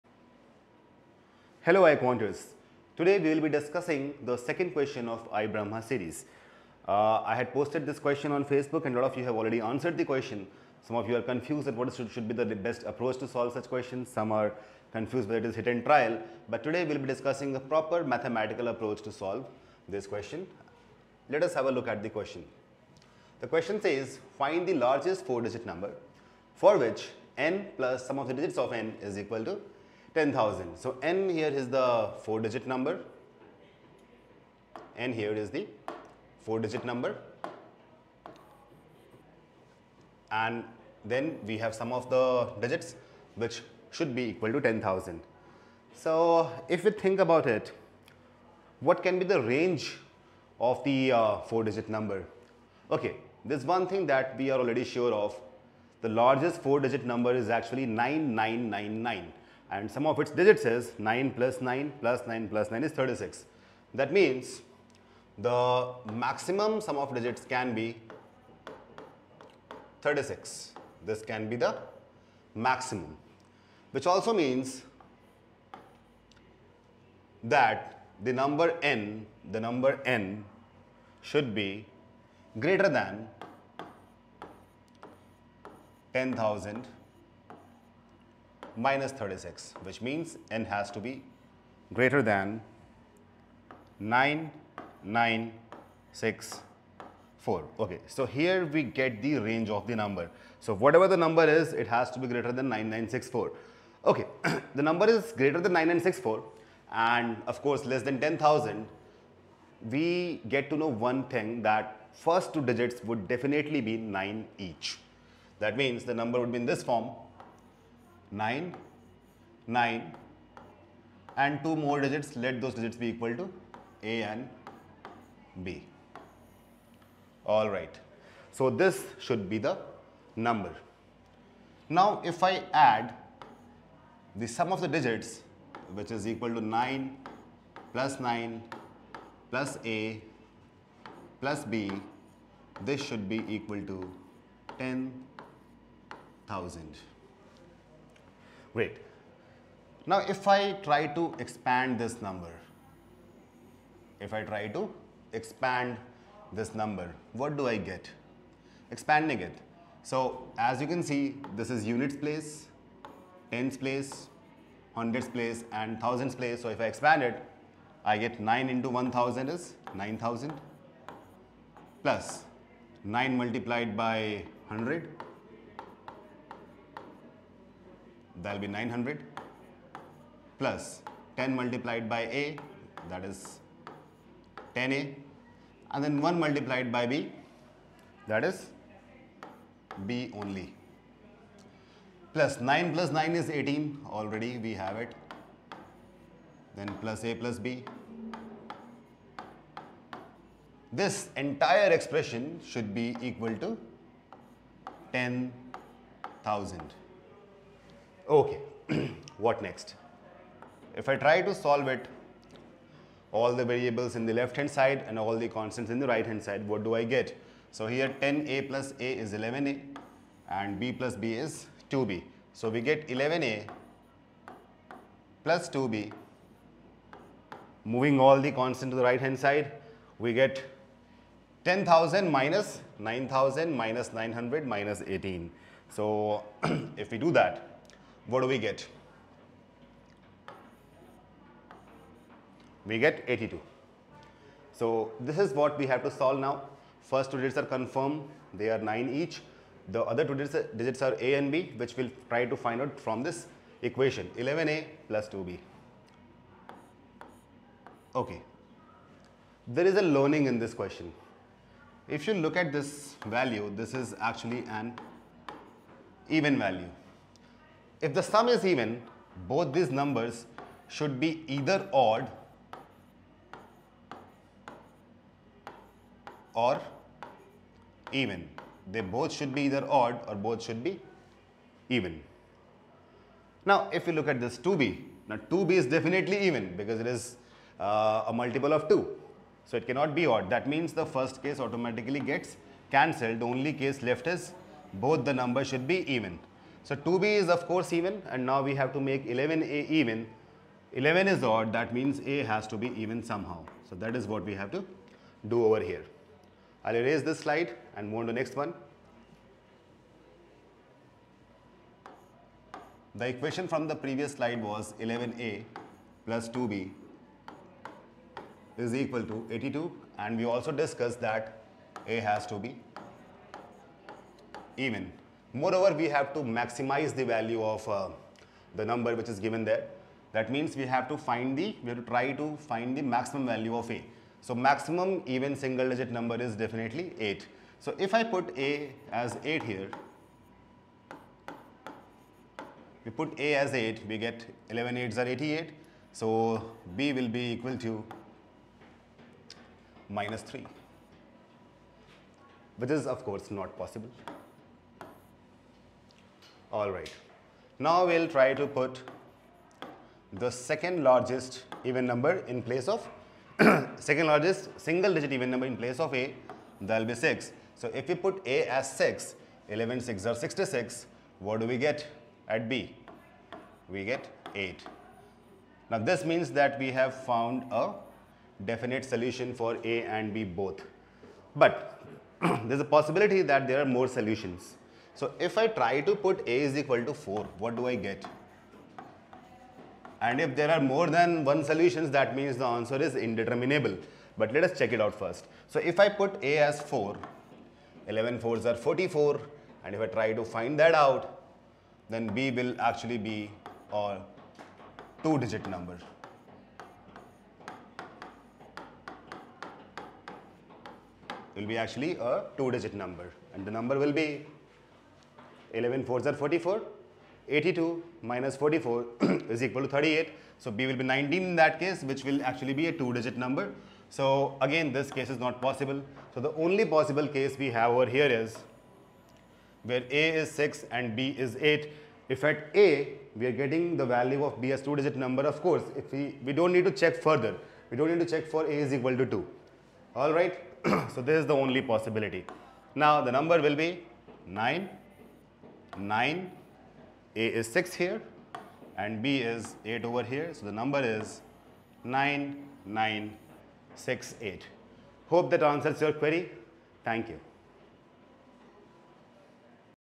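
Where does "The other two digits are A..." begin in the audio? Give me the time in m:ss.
4:09.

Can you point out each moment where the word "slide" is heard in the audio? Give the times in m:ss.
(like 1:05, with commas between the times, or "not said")
5:07, 5:14.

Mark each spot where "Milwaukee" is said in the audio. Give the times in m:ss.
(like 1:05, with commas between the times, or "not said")
not said.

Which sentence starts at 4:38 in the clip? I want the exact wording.
They both should be either odd or both should be even.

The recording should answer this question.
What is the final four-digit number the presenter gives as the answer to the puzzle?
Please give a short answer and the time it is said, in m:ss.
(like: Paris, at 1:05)
9968, at 7:32.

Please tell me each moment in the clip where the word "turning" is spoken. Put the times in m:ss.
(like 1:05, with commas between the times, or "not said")
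not said.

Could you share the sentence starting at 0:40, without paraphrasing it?
And then we have sum of the digits which should be equal to 10,000.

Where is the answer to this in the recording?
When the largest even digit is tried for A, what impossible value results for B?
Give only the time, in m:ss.
5:50.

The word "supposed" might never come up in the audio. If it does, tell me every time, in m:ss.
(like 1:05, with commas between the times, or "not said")
not said.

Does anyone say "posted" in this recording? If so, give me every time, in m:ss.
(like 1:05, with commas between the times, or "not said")
0:07.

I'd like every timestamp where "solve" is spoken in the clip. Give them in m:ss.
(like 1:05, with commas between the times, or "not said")
0:13, 0:19, 3:31, 4:06.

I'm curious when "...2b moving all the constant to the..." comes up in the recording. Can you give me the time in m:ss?
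3:45.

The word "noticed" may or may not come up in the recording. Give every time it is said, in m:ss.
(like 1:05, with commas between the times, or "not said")
not said.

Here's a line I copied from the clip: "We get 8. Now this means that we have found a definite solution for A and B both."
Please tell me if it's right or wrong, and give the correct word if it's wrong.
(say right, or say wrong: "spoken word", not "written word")
right.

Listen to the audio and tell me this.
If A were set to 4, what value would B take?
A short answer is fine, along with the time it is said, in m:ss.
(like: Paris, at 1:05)
19, at 7:01.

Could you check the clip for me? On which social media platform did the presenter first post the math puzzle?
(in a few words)
Facebook.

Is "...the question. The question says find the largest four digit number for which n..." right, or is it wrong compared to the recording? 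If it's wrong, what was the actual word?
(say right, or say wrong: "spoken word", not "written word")
right.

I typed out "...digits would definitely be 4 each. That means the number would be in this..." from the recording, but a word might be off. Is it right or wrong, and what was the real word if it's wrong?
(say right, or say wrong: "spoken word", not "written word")
wrong: "9", not "4".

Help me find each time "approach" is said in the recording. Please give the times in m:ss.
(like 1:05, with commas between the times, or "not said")
0:12, 0:18.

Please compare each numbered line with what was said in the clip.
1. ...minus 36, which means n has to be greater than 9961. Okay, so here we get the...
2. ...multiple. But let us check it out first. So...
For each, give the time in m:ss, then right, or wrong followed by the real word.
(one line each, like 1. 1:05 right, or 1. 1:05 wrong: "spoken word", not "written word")
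1. 1:28 wrong: "9964", not "9961"
2. 6:33 wrong: "indeterminable", not "multiple".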